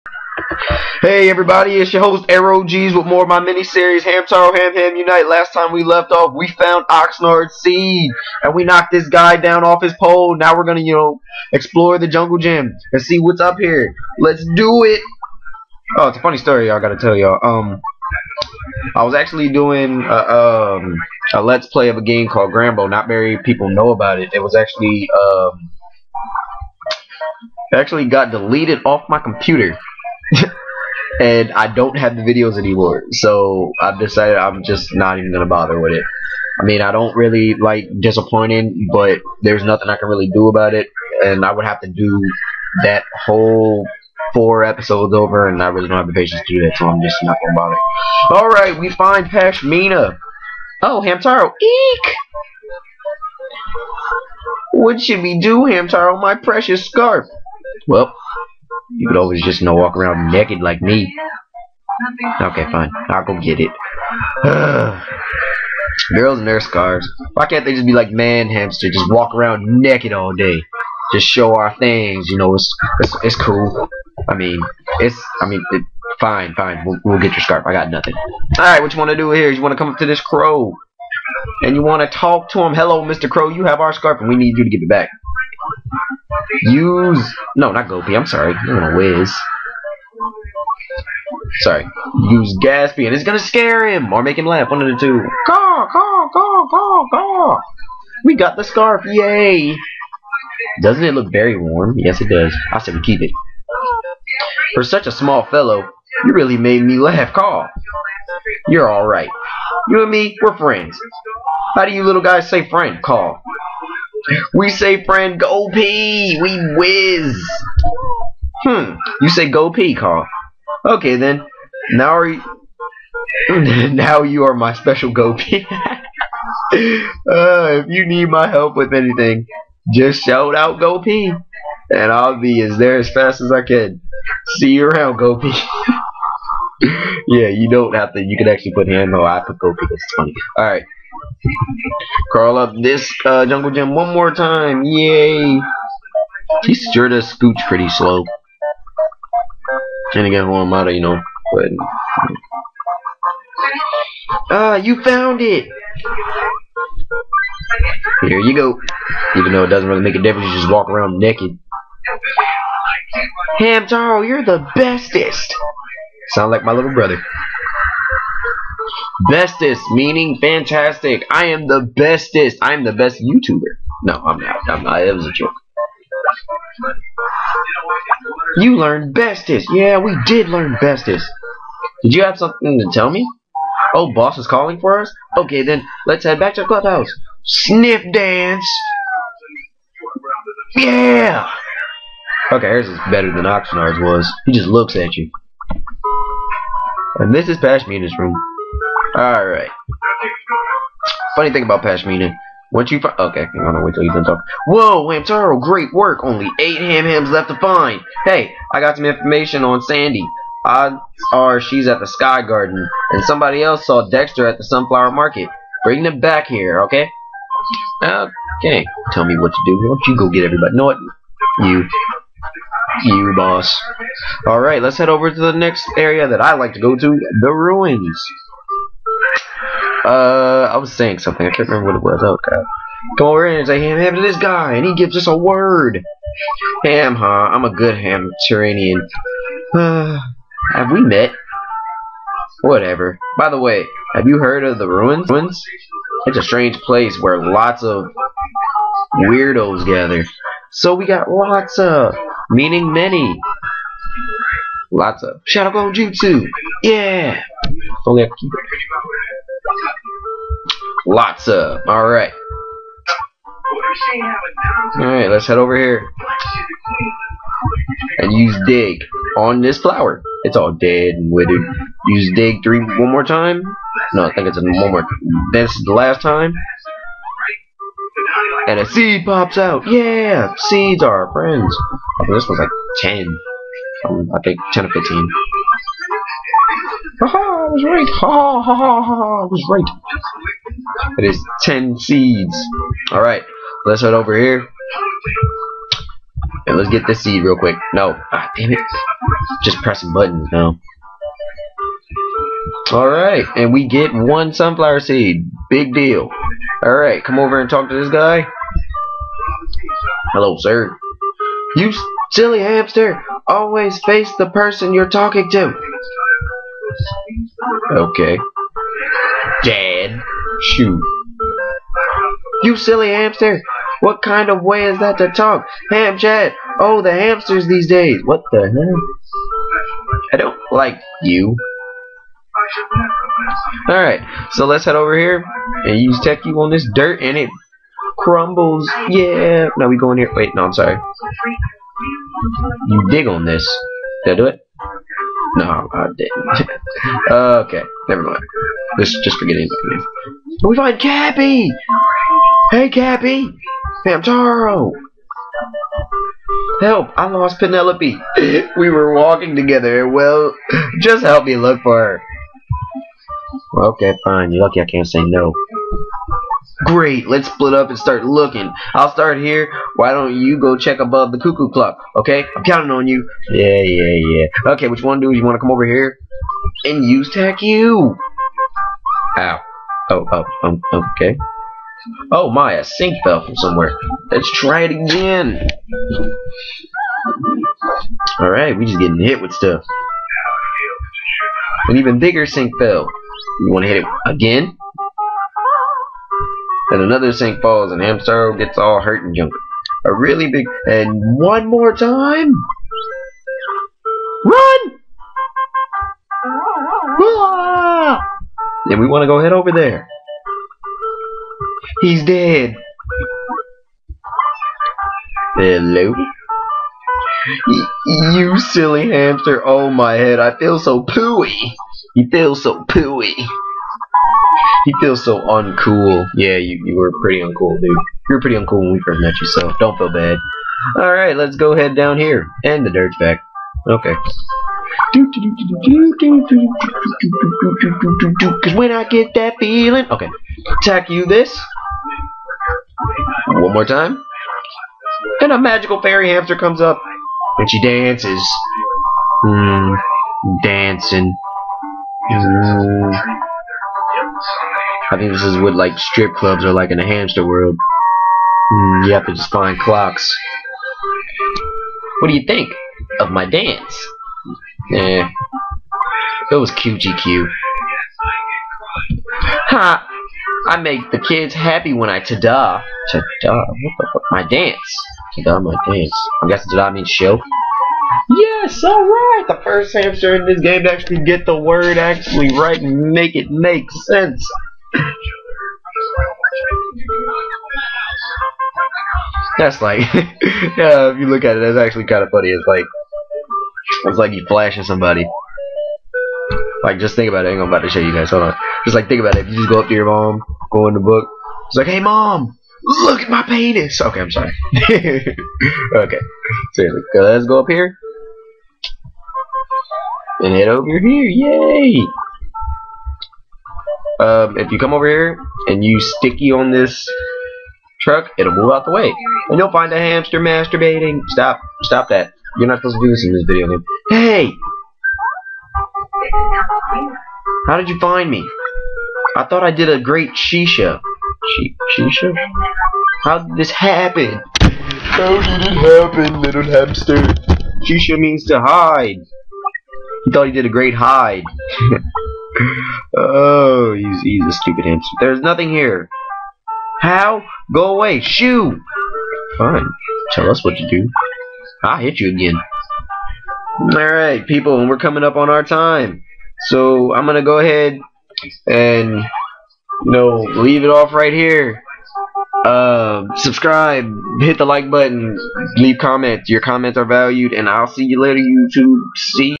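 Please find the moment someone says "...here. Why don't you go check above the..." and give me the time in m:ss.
6:09.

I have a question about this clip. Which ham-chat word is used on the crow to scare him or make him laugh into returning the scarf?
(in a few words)
Gaspy.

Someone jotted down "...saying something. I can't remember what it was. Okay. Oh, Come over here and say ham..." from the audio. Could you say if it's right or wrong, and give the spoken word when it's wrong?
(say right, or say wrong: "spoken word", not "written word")
right.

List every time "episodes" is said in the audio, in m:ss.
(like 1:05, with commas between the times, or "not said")
0:44.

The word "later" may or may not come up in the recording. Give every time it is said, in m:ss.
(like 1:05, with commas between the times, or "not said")
9:28.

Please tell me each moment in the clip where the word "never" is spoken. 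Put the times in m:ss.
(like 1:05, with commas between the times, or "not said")
5:48.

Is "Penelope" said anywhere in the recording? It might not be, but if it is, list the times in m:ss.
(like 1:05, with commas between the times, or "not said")
5:57.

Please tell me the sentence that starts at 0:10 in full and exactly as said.
Now we're gonna, you know, explore the jungle gym and see what's up here.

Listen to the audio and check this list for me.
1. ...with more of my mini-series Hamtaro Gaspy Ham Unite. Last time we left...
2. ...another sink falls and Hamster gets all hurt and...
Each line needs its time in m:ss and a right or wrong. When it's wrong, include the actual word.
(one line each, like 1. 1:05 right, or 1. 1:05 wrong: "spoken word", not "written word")
1. 0:02 wrong: "Ham", not "Gaspy"
2. 6:36 right.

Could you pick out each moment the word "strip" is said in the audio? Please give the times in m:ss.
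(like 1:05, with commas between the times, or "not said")
7:35.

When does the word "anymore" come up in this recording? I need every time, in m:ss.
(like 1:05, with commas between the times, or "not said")
0:32.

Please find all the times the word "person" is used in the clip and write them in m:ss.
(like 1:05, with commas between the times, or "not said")
5:14.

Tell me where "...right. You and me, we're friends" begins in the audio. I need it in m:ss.
1:49.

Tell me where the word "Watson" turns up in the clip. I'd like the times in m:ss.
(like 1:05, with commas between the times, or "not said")
not said.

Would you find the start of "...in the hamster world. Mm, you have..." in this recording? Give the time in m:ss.
7:36.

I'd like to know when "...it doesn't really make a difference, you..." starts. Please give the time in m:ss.
2:39.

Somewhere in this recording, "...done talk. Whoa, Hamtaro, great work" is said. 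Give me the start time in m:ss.
3:24.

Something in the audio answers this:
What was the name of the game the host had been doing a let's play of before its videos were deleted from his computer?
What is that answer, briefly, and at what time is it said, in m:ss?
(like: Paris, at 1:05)
Grambo, at 0:22.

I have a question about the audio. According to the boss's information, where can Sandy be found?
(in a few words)
Sky Garden.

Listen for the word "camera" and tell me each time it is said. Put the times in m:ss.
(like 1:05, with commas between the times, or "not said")
not said.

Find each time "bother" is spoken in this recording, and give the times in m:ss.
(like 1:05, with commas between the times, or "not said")
0:35, 0:47.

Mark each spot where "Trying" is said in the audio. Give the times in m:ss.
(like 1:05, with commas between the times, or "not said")
2:30.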